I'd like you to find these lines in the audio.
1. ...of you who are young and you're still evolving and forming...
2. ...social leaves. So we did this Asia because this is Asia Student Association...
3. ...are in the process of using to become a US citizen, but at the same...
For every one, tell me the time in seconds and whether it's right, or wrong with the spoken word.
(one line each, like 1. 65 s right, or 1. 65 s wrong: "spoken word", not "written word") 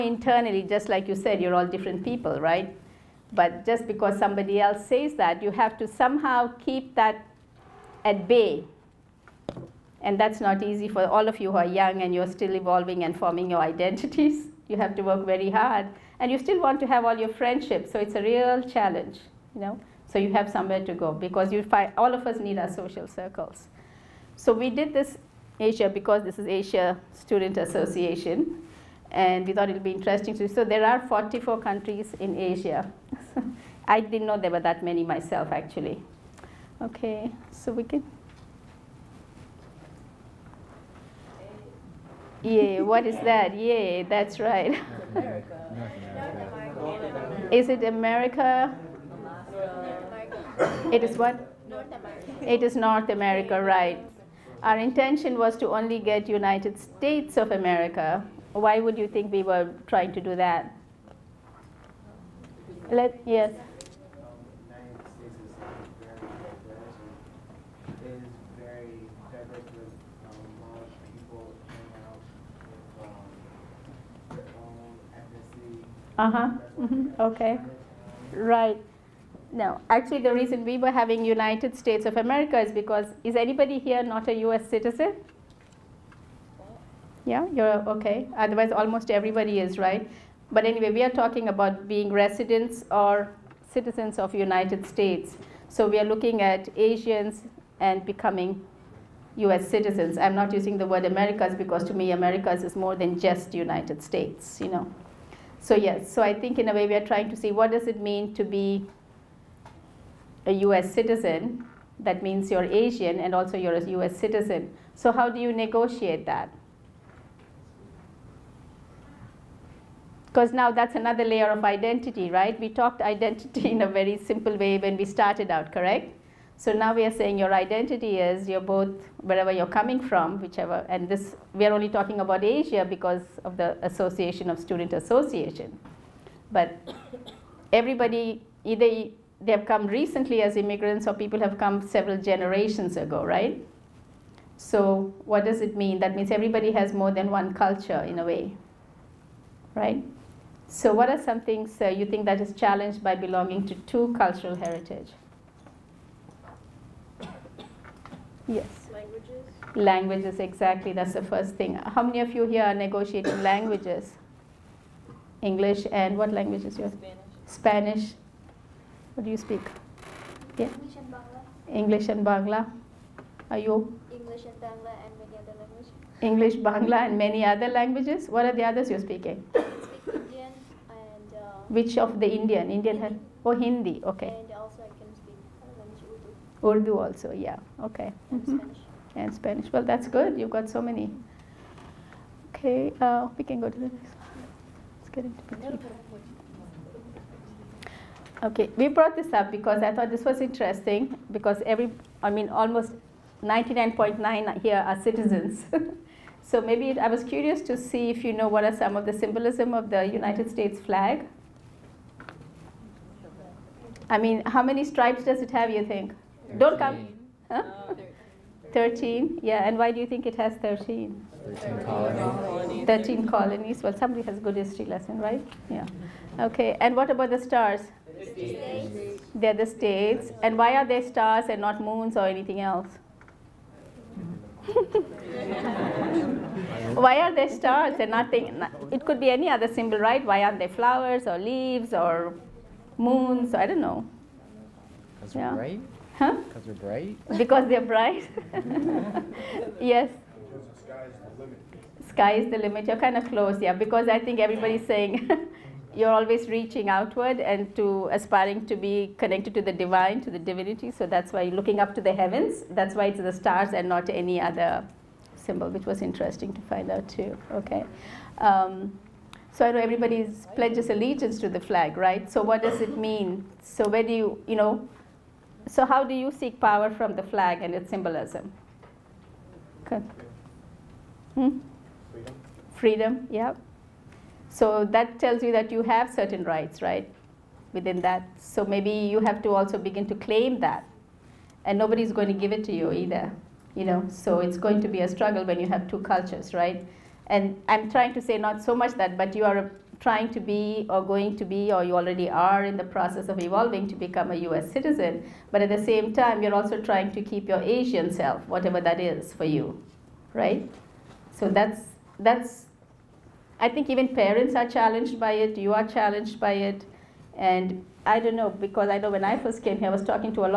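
1. 11 s right
2. 22 s wrong: "circles", not "leaves"
3. 302 s wrong: "evolving", not "using".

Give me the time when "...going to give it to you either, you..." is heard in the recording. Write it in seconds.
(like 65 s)
292 s.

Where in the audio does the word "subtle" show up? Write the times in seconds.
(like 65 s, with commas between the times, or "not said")
not said.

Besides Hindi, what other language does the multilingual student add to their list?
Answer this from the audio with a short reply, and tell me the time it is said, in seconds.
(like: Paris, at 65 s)
Urdu, at 186 s.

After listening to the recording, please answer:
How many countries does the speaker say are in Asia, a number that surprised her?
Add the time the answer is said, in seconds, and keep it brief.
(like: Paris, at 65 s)
44, at 31 s.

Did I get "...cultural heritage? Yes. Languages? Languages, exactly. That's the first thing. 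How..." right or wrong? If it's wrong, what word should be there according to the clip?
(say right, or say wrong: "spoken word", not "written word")
right.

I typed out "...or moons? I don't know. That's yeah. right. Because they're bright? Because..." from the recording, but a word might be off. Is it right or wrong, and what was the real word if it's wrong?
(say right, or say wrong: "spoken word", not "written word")
right.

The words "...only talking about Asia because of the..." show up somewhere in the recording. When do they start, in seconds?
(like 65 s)
131 s.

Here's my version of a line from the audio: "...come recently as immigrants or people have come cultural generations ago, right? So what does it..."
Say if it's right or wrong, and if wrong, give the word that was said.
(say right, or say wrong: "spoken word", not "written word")
wrong: "several", not "cultural".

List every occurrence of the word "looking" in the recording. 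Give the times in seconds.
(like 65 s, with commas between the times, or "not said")
96 s, 261 s.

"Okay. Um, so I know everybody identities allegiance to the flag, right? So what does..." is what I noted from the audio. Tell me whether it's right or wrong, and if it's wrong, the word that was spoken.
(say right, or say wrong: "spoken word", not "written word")
wrong: "pledges", not "identities".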